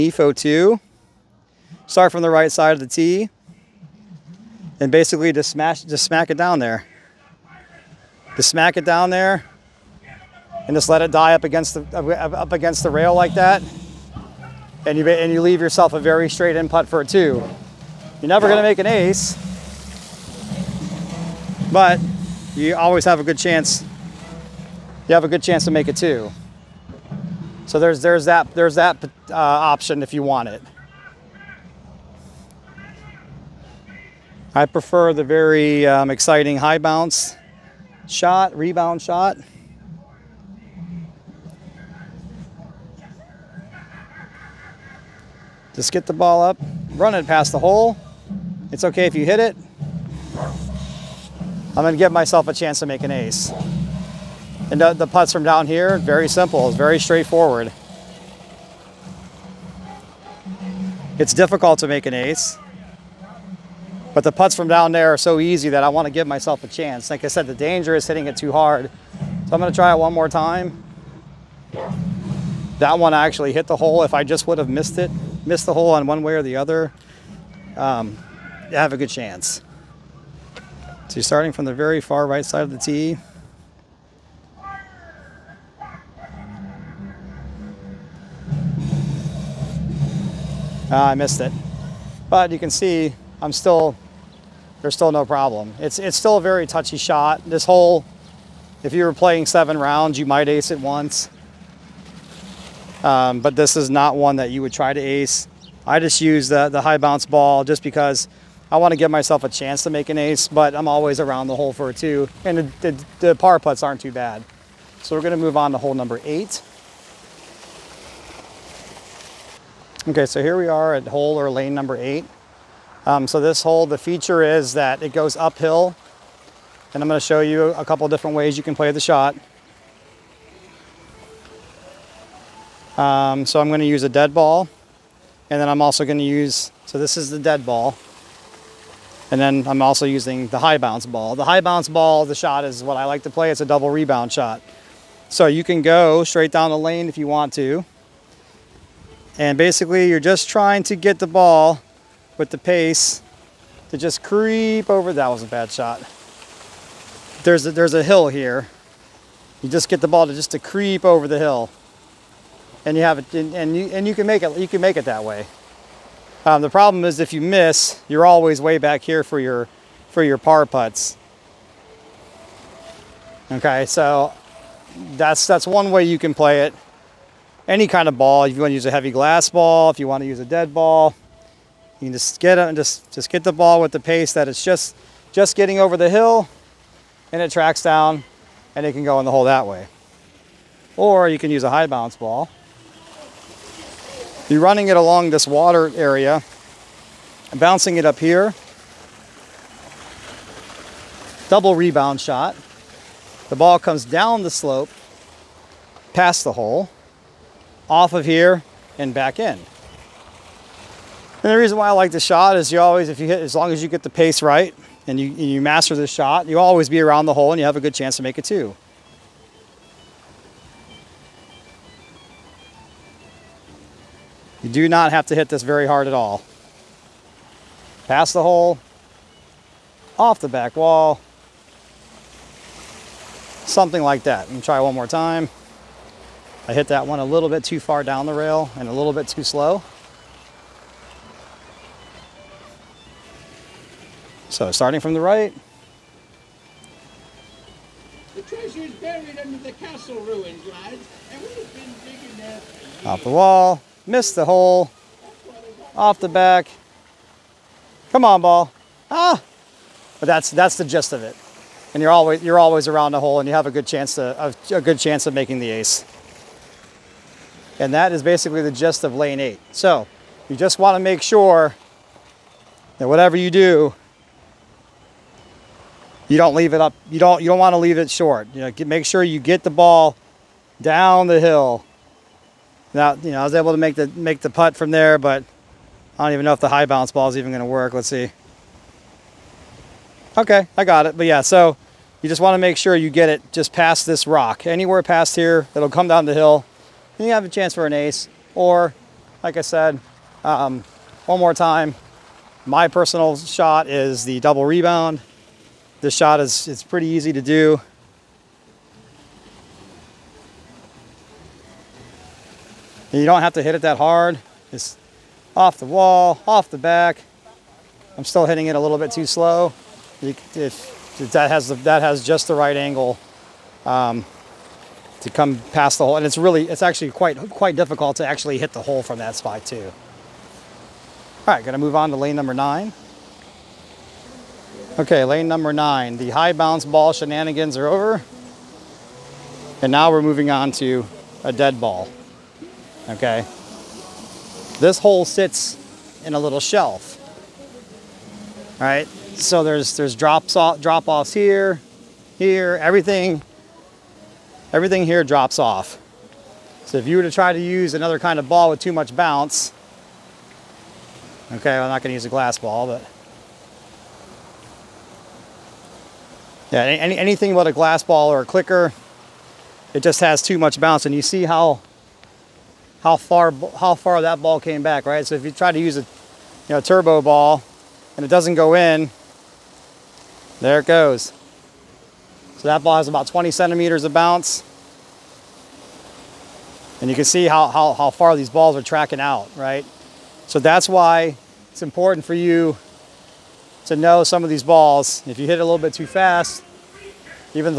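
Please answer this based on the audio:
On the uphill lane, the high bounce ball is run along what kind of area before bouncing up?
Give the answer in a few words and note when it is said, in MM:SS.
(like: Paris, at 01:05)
Water area, at 03:15.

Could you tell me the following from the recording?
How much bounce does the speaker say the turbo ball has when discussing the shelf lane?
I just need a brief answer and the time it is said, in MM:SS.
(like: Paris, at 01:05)
20 centimeters, at 06:23.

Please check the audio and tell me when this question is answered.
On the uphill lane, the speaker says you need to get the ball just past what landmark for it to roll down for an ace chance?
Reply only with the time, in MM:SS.
04:54.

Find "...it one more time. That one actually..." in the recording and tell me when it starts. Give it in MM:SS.
01:09.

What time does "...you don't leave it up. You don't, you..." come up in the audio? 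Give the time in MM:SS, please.
04:36.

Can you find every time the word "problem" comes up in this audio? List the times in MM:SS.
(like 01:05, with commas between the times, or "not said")
01:35, 02:46.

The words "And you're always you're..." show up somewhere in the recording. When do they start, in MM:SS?
04:21.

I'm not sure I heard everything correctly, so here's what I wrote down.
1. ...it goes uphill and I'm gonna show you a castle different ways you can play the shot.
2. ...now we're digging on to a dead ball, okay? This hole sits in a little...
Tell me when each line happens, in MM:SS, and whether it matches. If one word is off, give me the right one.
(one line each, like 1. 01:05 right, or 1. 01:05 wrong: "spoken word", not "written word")
1. 02:05 wrong: "couple", not "castle"
2. 05:39 wrong: "moving", not "digging".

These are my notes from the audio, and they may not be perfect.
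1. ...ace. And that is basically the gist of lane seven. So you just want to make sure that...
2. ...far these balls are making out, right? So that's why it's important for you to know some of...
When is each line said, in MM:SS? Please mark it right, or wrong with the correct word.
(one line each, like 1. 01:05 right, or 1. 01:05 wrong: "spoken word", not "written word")
1. 04:25 wrong: "eight", not "seven"
2. 06:28 wrong: "tracking", not "making".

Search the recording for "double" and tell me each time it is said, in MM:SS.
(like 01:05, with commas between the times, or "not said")
02:23, 03:21, 05:04.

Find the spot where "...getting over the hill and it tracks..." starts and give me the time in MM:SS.
03:05.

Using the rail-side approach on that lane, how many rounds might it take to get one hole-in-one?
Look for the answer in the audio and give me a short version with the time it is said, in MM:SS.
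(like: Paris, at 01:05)
7, at 01:39.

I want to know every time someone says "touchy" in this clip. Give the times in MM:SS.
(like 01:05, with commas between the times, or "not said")
01:36.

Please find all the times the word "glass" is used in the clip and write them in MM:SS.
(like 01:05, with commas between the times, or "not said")
02:59, 06:02, 06:07.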